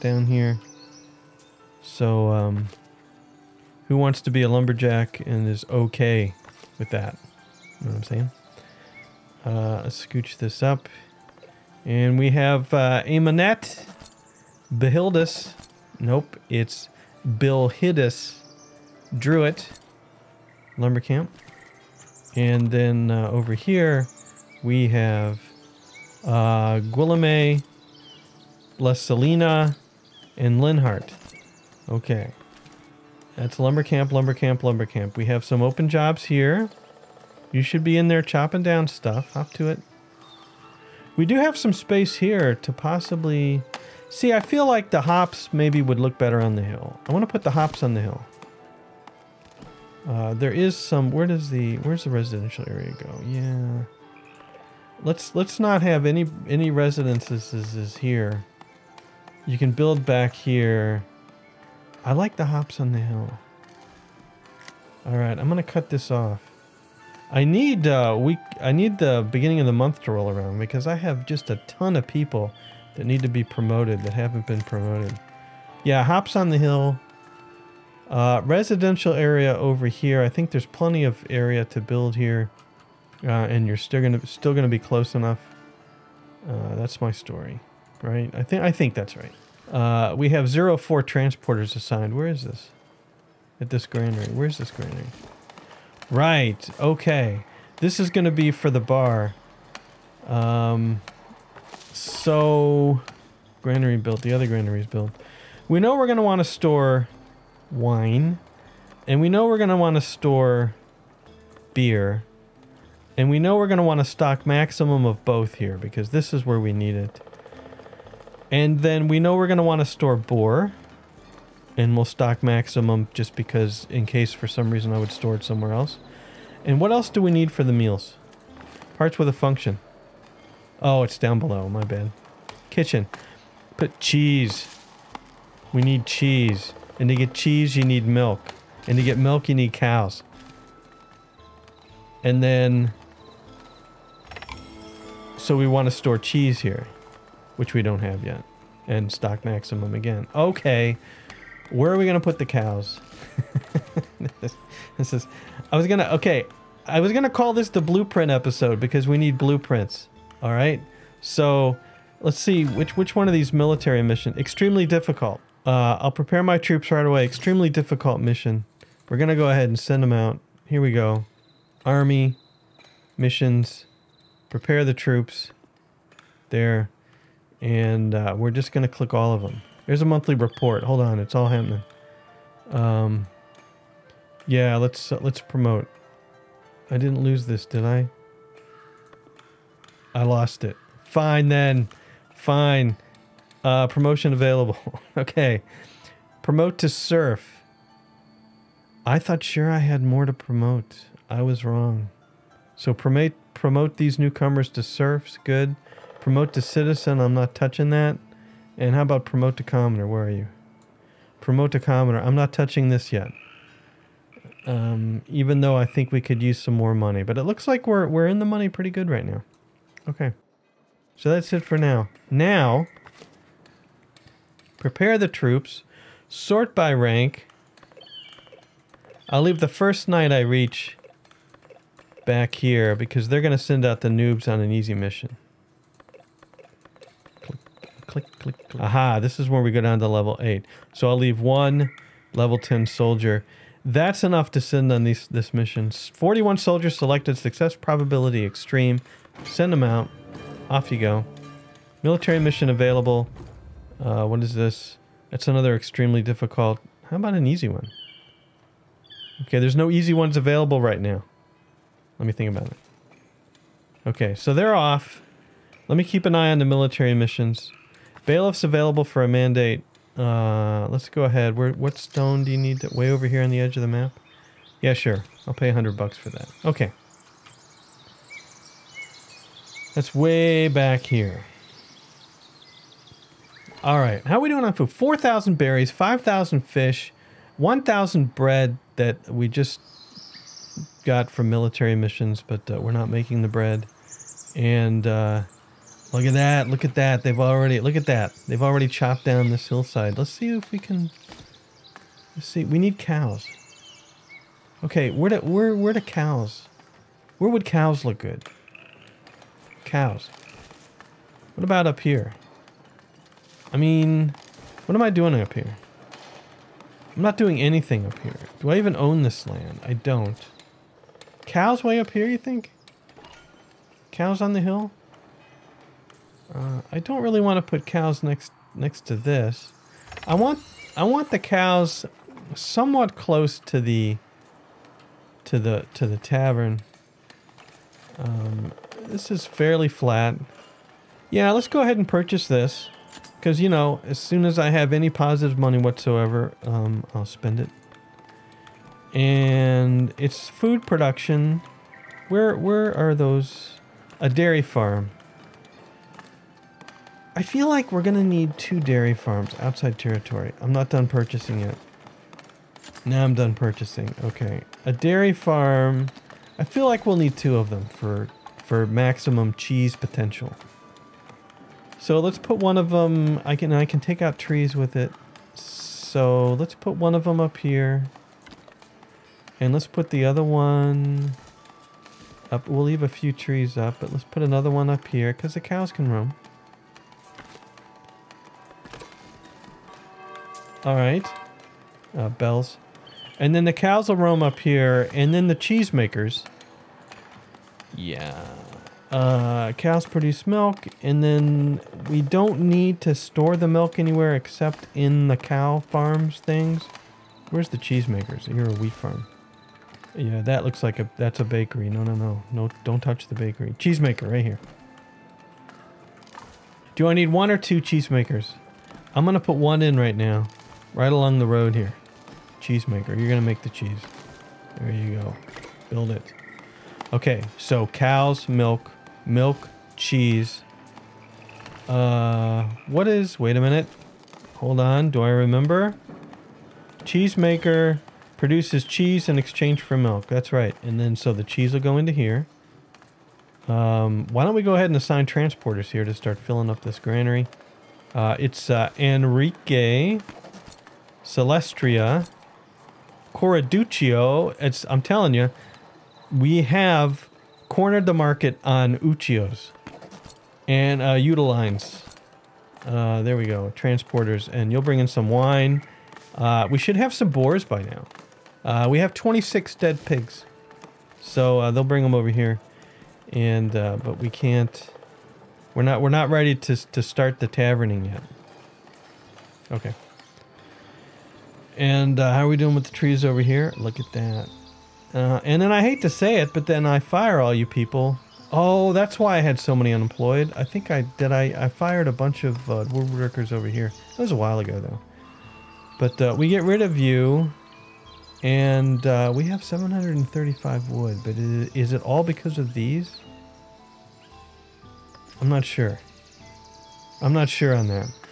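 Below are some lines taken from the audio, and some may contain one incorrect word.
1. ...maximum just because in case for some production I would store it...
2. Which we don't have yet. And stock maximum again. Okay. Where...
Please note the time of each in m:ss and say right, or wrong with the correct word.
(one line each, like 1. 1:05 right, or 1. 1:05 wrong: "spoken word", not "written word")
1. 2:02 wrong: "reason", not "production"
2. 2:27 right.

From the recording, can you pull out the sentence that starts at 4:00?
So I'll leave one level 10 soldier.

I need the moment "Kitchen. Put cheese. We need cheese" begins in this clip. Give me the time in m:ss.
2:12.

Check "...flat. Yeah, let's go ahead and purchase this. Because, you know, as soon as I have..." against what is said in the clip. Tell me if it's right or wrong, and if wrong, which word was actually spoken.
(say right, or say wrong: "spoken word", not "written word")
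right.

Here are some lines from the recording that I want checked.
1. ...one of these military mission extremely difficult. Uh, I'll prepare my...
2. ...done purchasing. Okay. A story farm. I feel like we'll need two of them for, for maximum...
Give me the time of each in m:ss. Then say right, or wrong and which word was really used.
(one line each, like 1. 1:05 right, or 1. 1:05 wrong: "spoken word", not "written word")
1. 2:43 right
2. 6:03 wrong: "dairy", not "story".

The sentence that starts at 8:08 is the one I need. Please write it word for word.
Oh, that's why I had so many unemployed.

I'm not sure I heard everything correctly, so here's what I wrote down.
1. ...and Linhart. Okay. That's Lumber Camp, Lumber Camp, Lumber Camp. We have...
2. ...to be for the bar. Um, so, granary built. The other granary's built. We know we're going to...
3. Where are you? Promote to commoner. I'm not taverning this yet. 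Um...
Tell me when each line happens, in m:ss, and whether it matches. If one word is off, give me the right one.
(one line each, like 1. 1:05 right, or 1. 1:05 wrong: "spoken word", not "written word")
1. 0:30 right
2. 1:38 right
3. 3:30 wrong: "touching", not "taverning".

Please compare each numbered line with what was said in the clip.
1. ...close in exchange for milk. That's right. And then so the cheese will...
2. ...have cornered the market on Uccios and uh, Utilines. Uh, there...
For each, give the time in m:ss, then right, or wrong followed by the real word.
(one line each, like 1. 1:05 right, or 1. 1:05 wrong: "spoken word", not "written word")
1. 7:18 wrong: "cheese", not "close"
2. 7:36 right.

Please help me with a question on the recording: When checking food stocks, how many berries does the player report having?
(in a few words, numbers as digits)
4,000.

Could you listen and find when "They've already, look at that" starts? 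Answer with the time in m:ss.
4:57.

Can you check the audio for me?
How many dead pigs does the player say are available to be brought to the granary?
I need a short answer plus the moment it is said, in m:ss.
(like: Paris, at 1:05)
26, at 7:49.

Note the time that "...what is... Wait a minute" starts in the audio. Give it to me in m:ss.
7:12.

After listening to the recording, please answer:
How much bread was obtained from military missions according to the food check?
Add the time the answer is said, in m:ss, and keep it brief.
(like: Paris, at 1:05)
1,000, at 4:47.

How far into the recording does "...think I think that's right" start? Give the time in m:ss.
1:28.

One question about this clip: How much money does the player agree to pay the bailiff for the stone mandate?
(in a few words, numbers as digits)
100 bucks.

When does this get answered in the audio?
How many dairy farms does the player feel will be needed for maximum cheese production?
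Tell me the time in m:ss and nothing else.
5:58.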